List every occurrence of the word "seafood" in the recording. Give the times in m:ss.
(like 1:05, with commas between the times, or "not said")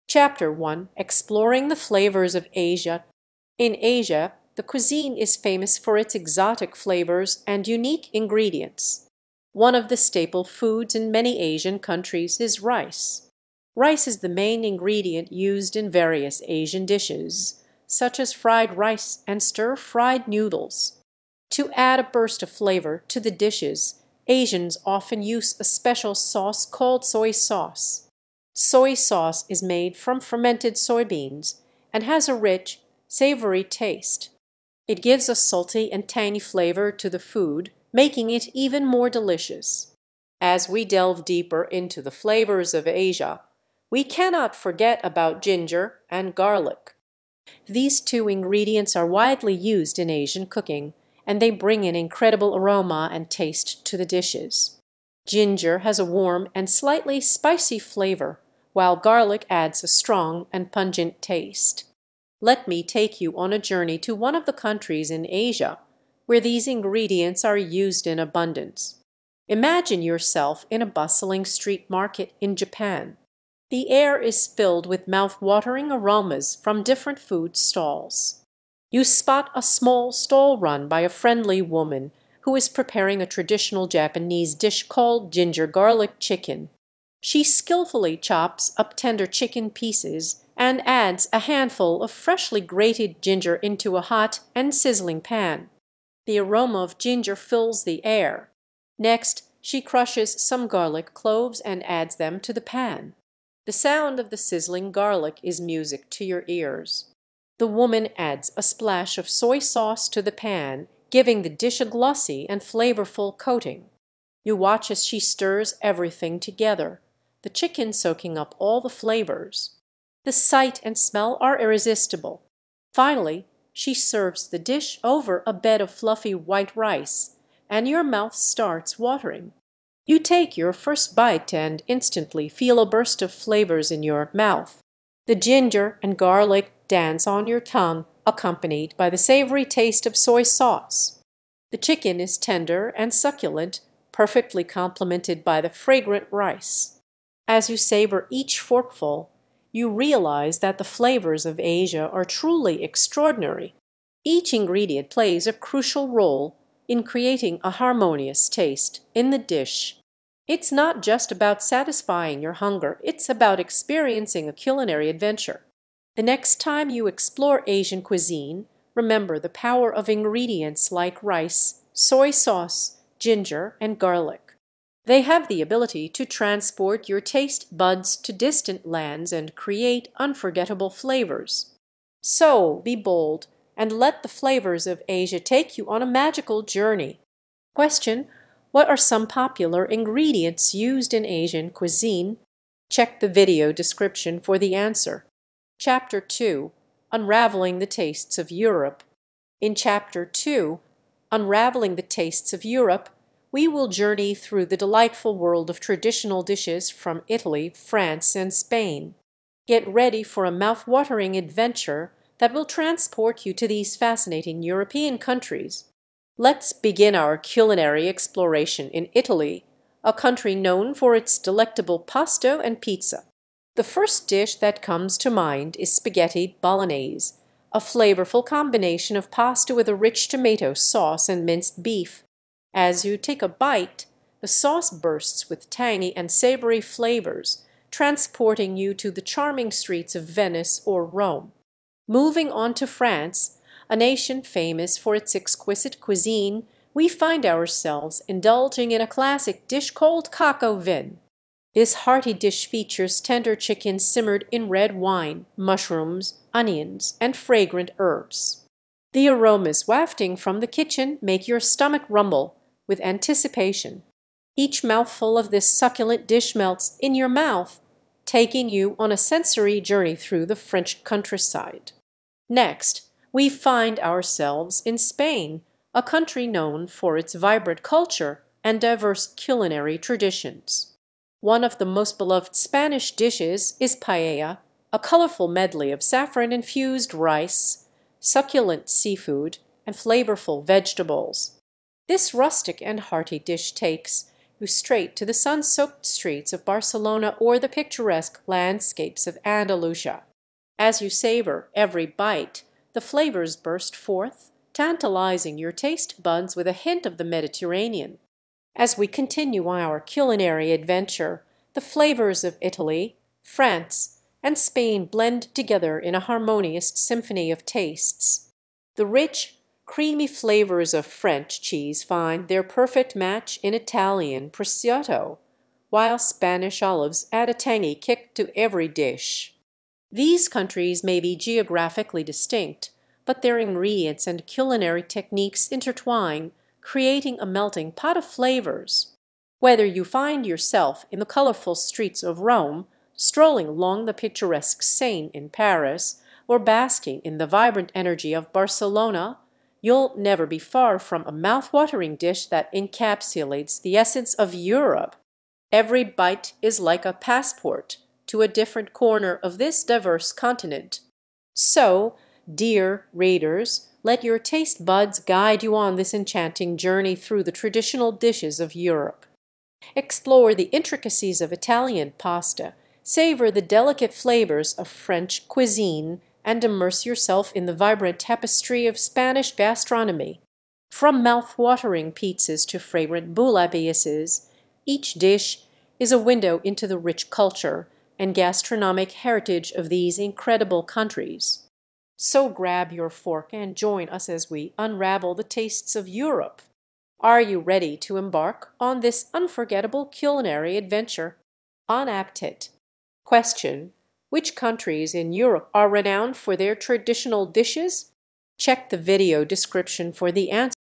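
4:48.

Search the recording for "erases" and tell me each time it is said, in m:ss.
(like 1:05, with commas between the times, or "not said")
not said.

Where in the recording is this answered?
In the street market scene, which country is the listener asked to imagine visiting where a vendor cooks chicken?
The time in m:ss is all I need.
1:12.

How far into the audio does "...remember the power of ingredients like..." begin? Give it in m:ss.
2:48.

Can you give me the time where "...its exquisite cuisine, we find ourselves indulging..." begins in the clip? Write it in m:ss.
4:05.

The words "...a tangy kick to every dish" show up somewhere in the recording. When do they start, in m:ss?
5:27.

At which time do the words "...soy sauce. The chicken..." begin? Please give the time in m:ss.
2:20.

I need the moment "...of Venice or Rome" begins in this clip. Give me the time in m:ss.
4:00.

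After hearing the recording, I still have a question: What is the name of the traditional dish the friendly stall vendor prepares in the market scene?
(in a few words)
ginger garlic chicken.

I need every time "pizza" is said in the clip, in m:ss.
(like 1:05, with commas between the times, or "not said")
3:42, 6:22.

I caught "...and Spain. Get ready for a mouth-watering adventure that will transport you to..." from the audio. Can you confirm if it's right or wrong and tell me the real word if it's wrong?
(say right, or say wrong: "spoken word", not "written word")
right.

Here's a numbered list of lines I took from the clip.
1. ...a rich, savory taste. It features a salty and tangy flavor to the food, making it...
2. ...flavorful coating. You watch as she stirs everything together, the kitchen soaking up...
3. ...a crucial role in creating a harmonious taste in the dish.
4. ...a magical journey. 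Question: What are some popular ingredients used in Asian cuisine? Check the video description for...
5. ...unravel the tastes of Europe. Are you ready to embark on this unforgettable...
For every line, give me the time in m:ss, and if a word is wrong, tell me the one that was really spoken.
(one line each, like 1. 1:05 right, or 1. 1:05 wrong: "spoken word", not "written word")
1. 0:32 wrong: "gives", not "features"
2. 1:52 wrong: "chicken", not "kitchen"
3. 2:35 right
4. 3:06 right
5. 6:34 right.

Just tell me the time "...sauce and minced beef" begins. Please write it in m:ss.
3:50.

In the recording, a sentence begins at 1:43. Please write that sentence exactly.
The sound of the sizzling garlic is music to your ears.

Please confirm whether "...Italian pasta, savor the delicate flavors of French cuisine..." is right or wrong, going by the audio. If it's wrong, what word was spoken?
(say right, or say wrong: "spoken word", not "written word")
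right.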